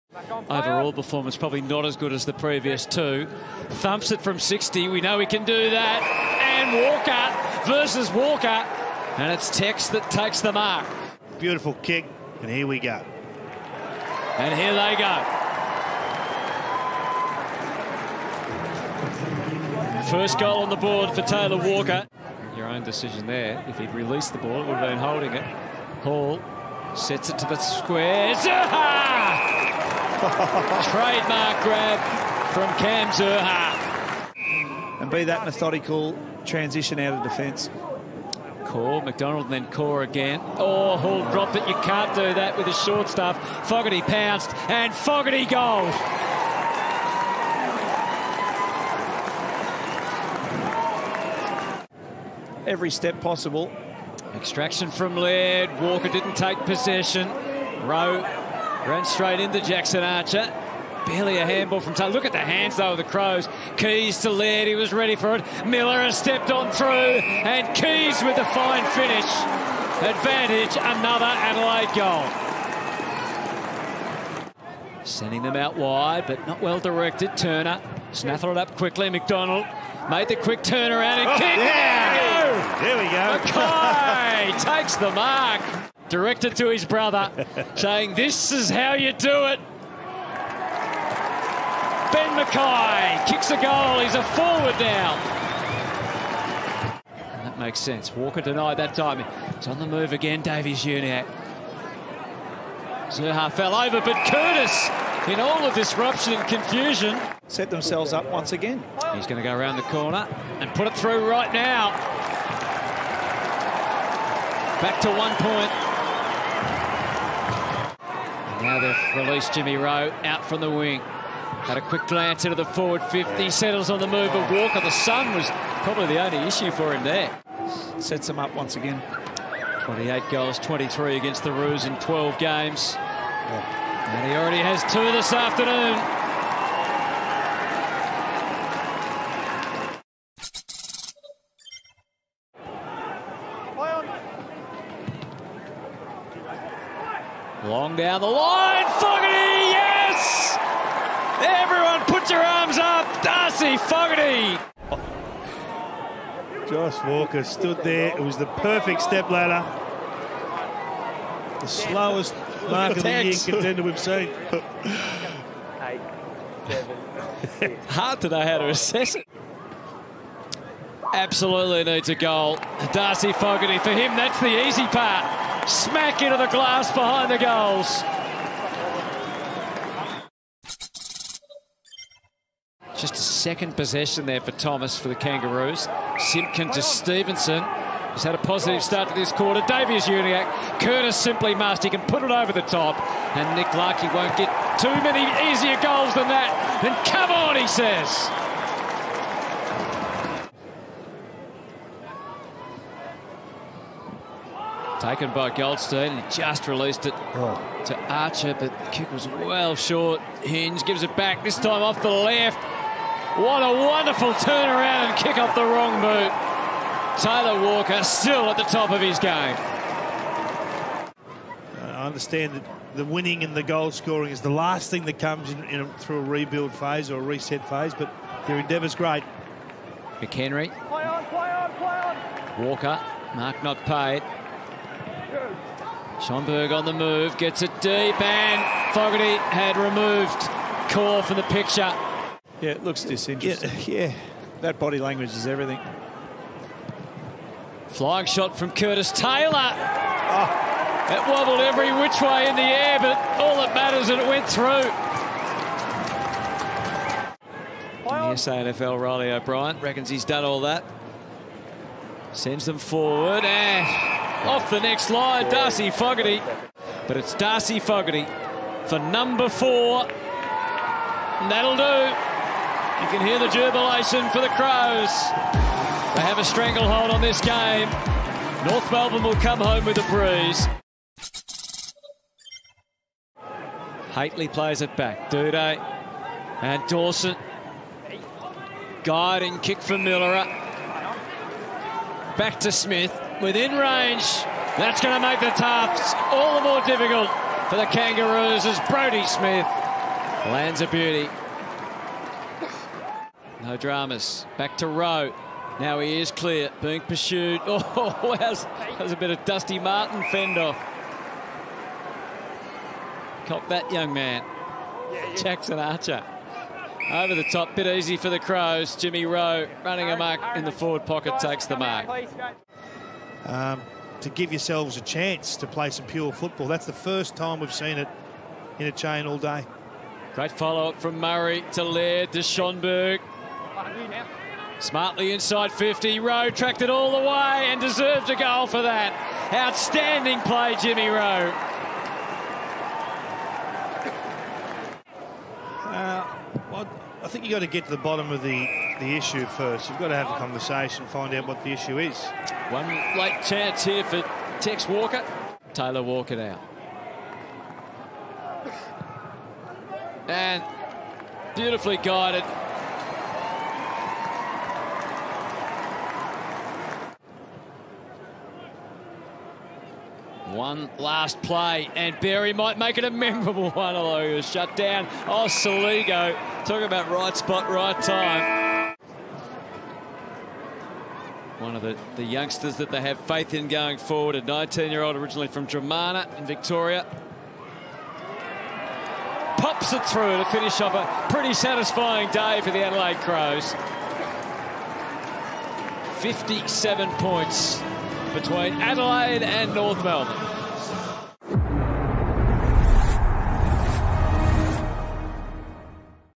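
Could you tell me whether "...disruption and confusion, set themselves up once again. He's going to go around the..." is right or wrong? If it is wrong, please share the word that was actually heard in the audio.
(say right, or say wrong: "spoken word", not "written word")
right.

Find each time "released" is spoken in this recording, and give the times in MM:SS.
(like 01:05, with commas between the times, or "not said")
00:23, 01:59, 03:26.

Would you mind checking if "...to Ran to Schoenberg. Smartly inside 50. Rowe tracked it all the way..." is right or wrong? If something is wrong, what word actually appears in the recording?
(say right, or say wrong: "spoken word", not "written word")
wrong: "Laird", not "Ran".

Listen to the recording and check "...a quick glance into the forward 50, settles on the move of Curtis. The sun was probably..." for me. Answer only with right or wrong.
wrong.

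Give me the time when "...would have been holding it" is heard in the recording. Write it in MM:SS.
00:24.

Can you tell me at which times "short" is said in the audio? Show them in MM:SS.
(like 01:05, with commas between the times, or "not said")
00:42, 03:29.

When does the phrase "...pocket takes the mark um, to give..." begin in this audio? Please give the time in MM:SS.
05:21.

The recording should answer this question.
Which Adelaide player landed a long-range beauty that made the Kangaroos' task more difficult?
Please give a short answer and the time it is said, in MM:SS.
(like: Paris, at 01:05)
Brodie Smith, at 04:58.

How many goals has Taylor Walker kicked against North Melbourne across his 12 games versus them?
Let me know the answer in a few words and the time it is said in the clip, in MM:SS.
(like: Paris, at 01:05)
23, at 02:10.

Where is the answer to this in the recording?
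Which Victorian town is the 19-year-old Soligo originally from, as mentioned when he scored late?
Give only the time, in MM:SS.
06:25.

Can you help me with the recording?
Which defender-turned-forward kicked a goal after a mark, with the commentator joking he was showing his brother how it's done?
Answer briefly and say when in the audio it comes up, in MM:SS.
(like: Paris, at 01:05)
Ben McKay, at 01:32.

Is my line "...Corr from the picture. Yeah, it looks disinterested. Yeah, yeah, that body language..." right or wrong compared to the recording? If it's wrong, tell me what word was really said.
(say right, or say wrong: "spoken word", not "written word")
right.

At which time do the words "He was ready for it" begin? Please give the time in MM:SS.
01:04.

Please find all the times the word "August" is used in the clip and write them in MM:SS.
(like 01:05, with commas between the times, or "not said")
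not said.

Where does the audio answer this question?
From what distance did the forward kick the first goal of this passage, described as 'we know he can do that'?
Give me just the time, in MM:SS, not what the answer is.
00:04.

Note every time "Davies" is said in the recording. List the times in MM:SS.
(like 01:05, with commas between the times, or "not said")
01:40, 03:09.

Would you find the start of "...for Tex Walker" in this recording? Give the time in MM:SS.
05:54.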